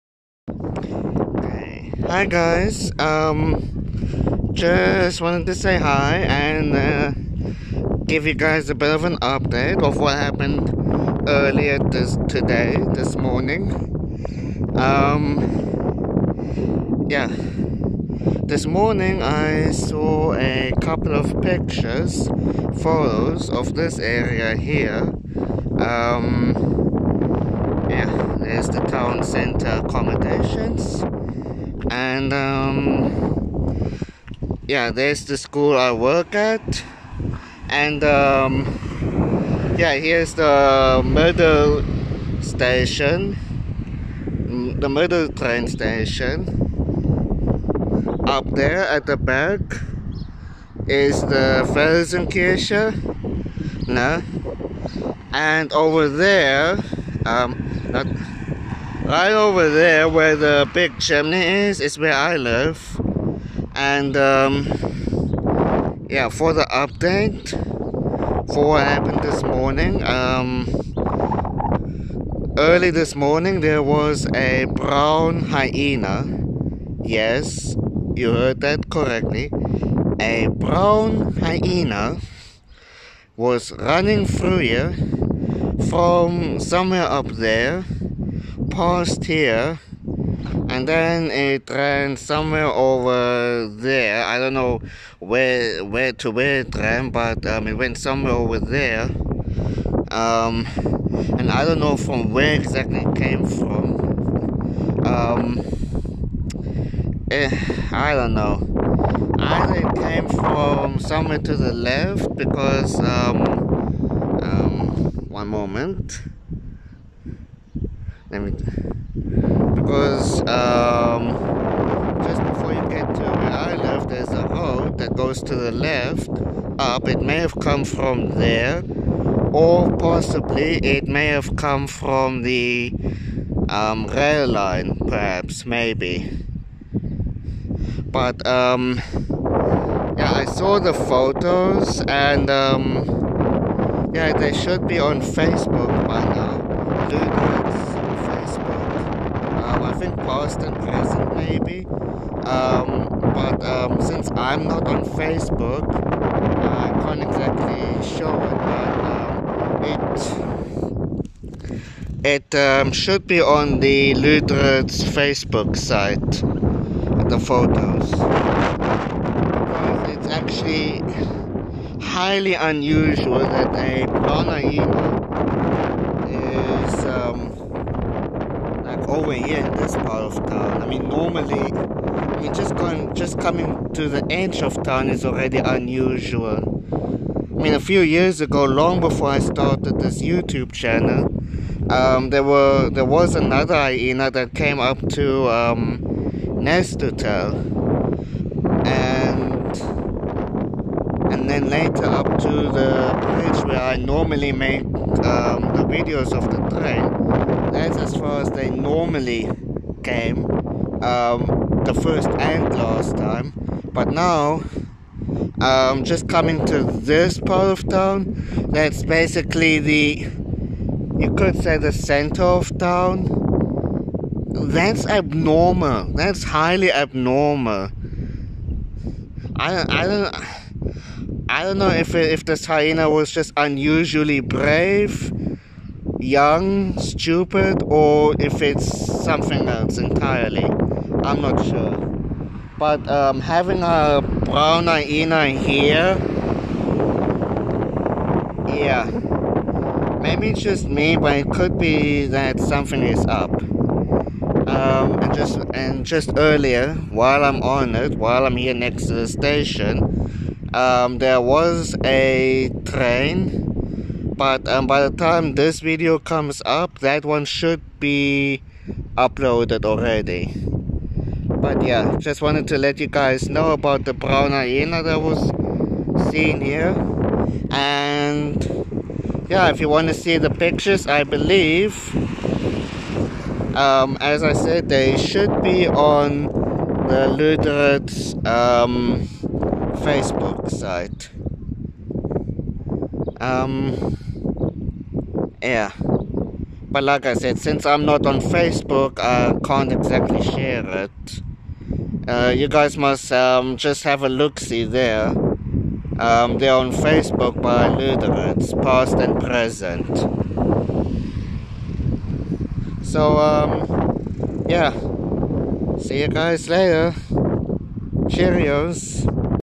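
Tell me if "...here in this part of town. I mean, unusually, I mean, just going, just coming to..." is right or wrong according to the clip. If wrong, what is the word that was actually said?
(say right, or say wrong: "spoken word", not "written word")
wrong: "normally", not "unusually".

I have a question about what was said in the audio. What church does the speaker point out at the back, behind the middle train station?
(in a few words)
Felsenkirche.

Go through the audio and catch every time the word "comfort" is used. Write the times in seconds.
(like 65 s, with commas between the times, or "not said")
not said.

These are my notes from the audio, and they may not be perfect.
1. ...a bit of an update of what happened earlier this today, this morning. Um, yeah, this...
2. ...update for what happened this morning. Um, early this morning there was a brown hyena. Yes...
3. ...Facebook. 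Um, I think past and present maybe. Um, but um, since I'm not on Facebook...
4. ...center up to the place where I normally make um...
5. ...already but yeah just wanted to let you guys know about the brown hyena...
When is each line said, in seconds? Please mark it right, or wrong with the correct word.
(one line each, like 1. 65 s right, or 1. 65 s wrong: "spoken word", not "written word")
1. 8 s right
2. 66 s right
3. 148 s right
4. 201 s wrong: "later", not "center"
5. 269 s right.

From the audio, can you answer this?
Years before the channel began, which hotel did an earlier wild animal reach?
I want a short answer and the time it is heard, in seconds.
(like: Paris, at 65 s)
Nest Hotel, at 196 s.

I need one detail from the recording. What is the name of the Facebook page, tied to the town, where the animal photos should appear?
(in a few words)
Luderitz, Past and Present.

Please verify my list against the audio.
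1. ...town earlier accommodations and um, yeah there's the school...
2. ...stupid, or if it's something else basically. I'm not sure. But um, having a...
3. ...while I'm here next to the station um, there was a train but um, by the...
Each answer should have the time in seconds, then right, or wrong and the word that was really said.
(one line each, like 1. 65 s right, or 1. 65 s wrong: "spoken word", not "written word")
1. 28 s wrong: "center", not "earlier"
2. 236 s wrong: "entirely", not "basically"
3. 258 s right.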